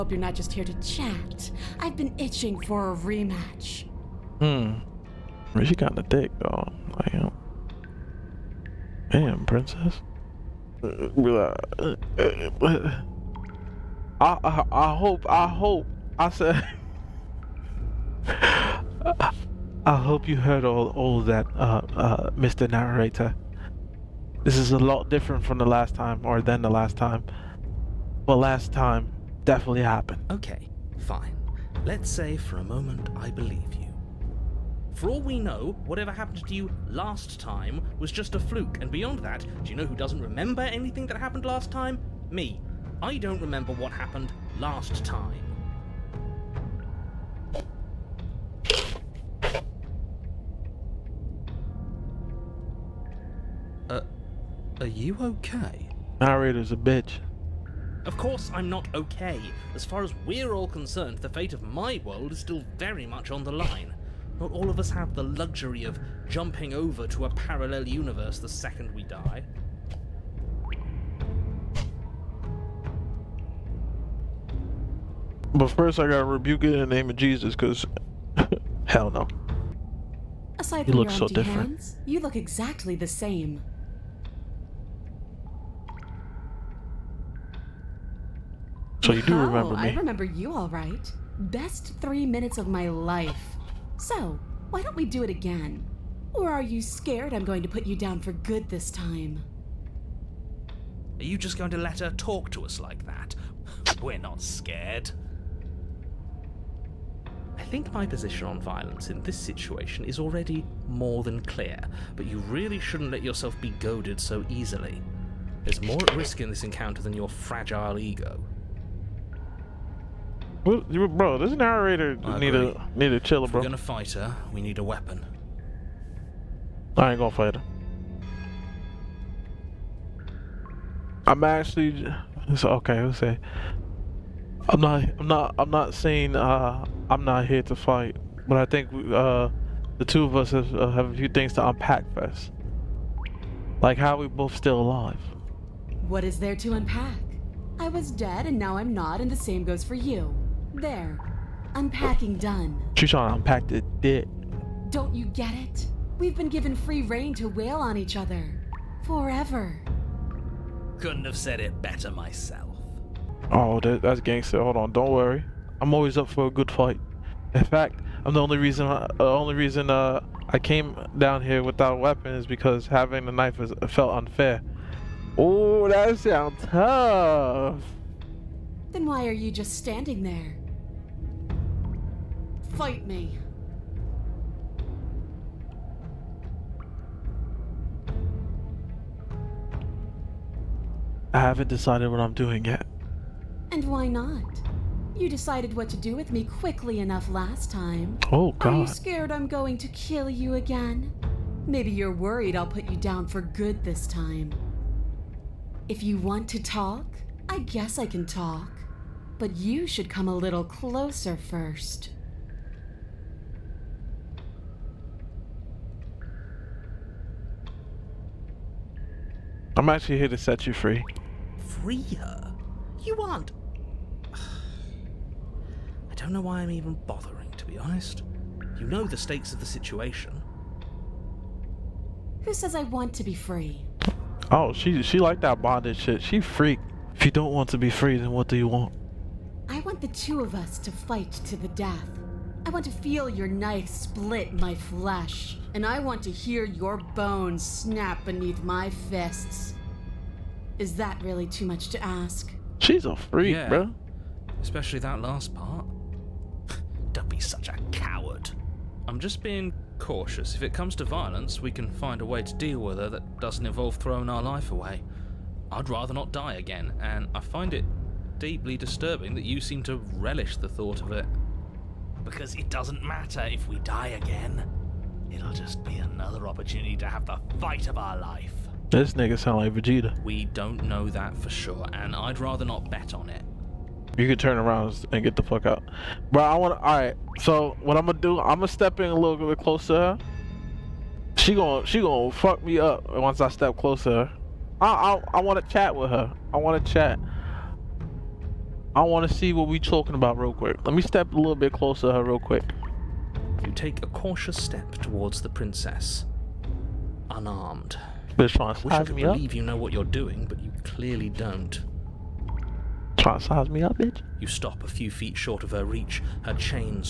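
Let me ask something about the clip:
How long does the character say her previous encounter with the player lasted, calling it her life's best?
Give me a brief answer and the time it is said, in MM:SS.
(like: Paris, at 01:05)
3 minutes, at 01:32.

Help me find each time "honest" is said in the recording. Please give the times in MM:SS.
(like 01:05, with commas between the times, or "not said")
03:47.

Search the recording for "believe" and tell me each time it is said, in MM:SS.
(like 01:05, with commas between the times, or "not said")
00:33, 05:09.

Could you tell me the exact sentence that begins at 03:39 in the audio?
I'm actually here to set you free.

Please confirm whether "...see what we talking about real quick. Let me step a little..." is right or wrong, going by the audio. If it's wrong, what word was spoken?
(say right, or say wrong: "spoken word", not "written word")
right.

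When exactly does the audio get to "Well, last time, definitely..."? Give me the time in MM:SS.
00:28.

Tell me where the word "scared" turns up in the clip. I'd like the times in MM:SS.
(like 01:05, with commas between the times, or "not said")
01:36, 01:44, 03:18.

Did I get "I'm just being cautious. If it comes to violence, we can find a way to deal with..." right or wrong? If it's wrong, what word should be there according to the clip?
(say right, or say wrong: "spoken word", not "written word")
right.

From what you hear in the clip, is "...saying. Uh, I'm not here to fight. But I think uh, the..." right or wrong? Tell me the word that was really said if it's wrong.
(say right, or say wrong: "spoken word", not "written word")
right.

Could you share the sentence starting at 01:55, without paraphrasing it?
There's more at risk in this encounter than your fragile ego.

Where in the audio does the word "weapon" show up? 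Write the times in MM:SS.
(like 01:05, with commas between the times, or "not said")
02:04, 02:51.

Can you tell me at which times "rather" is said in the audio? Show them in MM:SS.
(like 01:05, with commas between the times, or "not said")
04:25, 04:42.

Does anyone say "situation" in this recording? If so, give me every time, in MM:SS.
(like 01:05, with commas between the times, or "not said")
01:49, 03:49.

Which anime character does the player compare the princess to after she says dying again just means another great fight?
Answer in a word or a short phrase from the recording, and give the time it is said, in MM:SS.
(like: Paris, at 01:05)
Vegeta, at 04:39.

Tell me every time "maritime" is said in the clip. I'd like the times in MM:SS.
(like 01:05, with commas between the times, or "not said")
not said.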